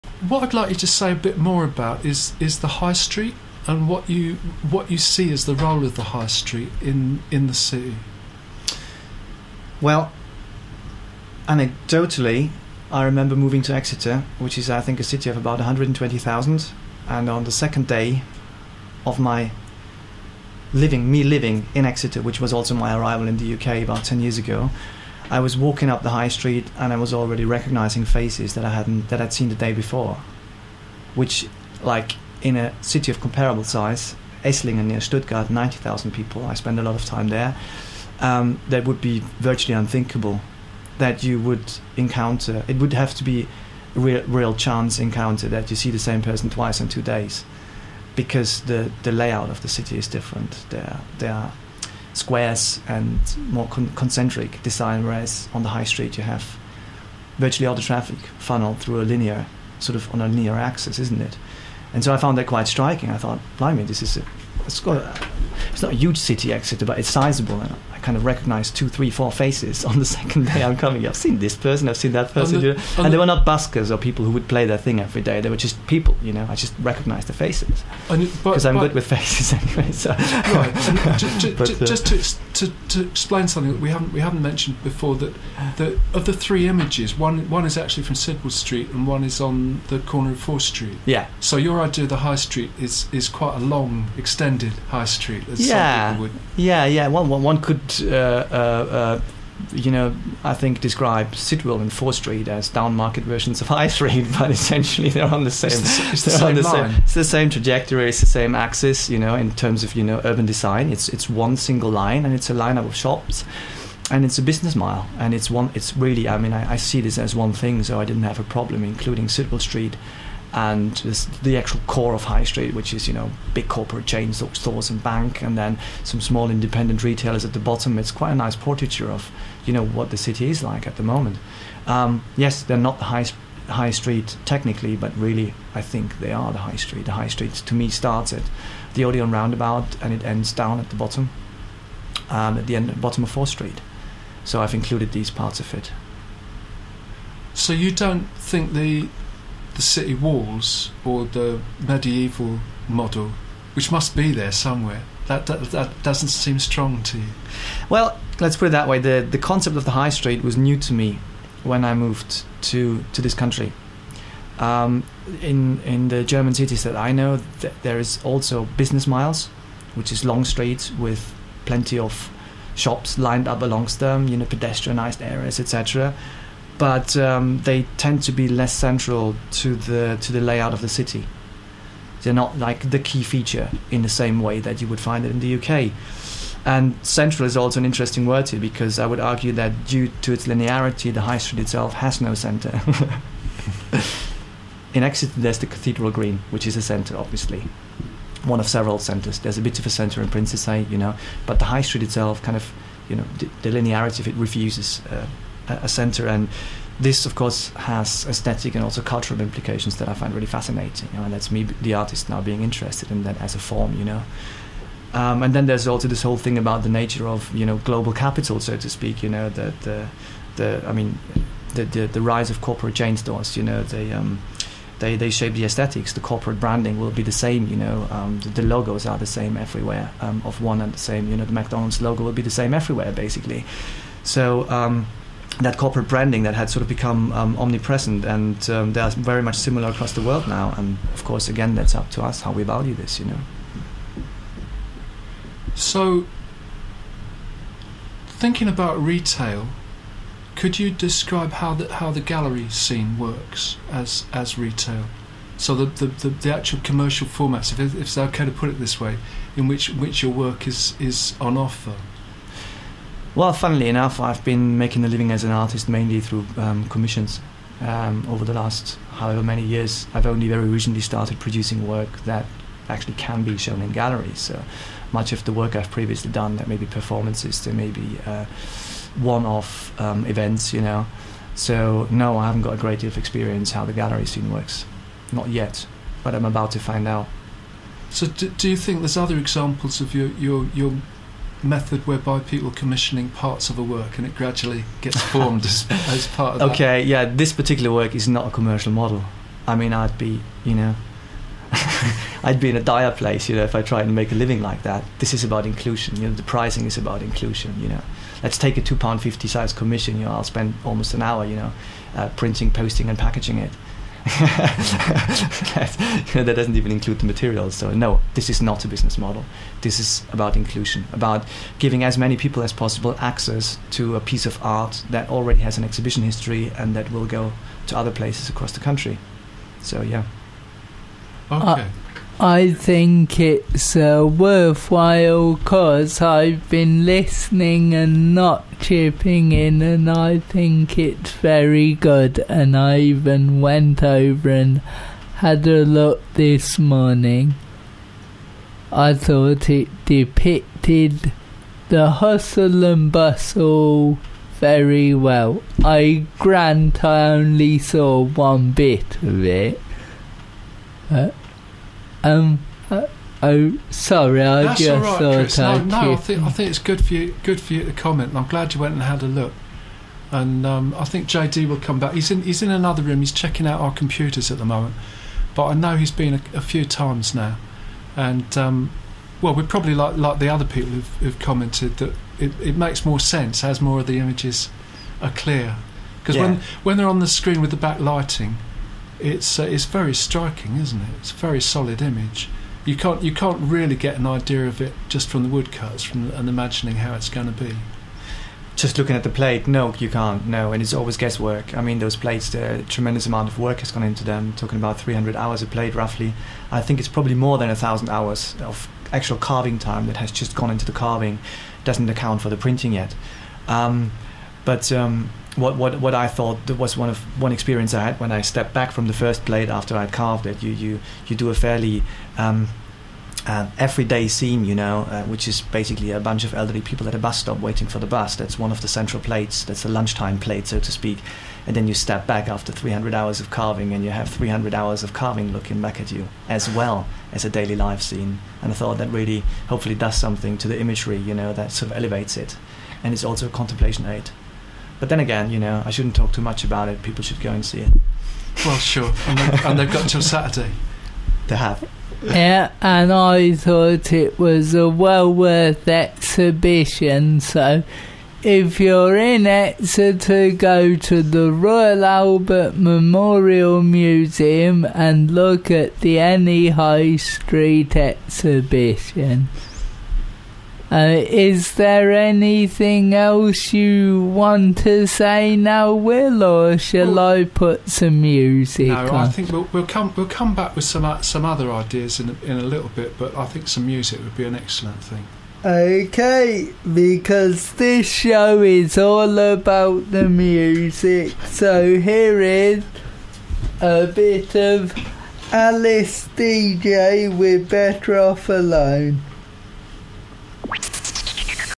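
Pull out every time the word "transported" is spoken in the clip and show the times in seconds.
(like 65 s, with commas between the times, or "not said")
not said.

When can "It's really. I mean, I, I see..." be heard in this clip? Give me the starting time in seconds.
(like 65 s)
115 s.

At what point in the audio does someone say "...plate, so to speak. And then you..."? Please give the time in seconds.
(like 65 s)
430 s.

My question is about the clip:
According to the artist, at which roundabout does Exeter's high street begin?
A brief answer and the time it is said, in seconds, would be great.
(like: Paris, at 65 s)
Odeon roundabout, at 139 s.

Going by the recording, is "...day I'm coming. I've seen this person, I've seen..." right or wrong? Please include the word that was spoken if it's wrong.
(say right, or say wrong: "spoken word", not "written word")
right.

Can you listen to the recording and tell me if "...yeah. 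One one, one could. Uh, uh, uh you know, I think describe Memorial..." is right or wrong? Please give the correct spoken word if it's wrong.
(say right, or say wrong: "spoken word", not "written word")
wrong: "Sidwell", not "Memorial".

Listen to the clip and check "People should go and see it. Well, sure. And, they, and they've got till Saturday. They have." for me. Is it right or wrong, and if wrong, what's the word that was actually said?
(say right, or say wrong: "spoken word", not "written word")
right.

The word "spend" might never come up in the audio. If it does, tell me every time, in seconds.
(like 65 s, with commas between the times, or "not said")
36 s, 310 s.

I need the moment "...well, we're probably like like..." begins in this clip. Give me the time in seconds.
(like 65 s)
379 s.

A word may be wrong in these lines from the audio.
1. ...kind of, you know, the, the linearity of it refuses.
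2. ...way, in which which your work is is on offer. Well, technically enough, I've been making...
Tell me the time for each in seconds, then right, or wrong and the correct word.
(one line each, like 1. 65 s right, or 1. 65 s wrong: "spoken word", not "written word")
1. 202 s right
2. 258 s wrong: "funnily", not "technically".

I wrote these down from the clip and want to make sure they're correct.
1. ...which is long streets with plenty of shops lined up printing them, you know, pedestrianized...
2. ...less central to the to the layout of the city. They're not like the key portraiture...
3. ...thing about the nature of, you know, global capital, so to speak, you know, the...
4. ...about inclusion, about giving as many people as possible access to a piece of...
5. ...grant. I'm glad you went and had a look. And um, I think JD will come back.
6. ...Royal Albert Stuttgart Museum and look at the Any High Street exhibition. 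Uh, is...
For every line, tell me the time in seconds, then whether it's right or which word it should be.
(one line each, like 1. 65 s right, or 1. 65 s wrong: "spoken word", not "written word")
1. 169 s wrong: "along", not "printing"
2. 178 s wrong: "feature", not "portraiture"
3. 216 s right
4. 320 s right
5. 367 s wrong: "comment", not "grant"
6. 461 s wrong: "Memorial", not "Stuttgart".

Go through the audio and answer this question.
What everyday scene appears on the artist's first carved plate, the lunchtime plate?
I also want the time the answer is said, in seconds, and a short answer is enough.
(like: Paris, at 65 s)
Elderly people at a bus stop, at 426 s.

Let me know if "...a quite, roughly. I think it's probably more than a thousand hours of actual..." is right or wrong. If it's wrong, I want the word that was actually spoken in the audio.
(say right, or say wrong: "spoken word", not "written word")
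wrong: "plate", not "quite".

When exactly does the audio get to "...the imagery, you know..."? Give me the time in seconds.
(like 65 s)
440 s.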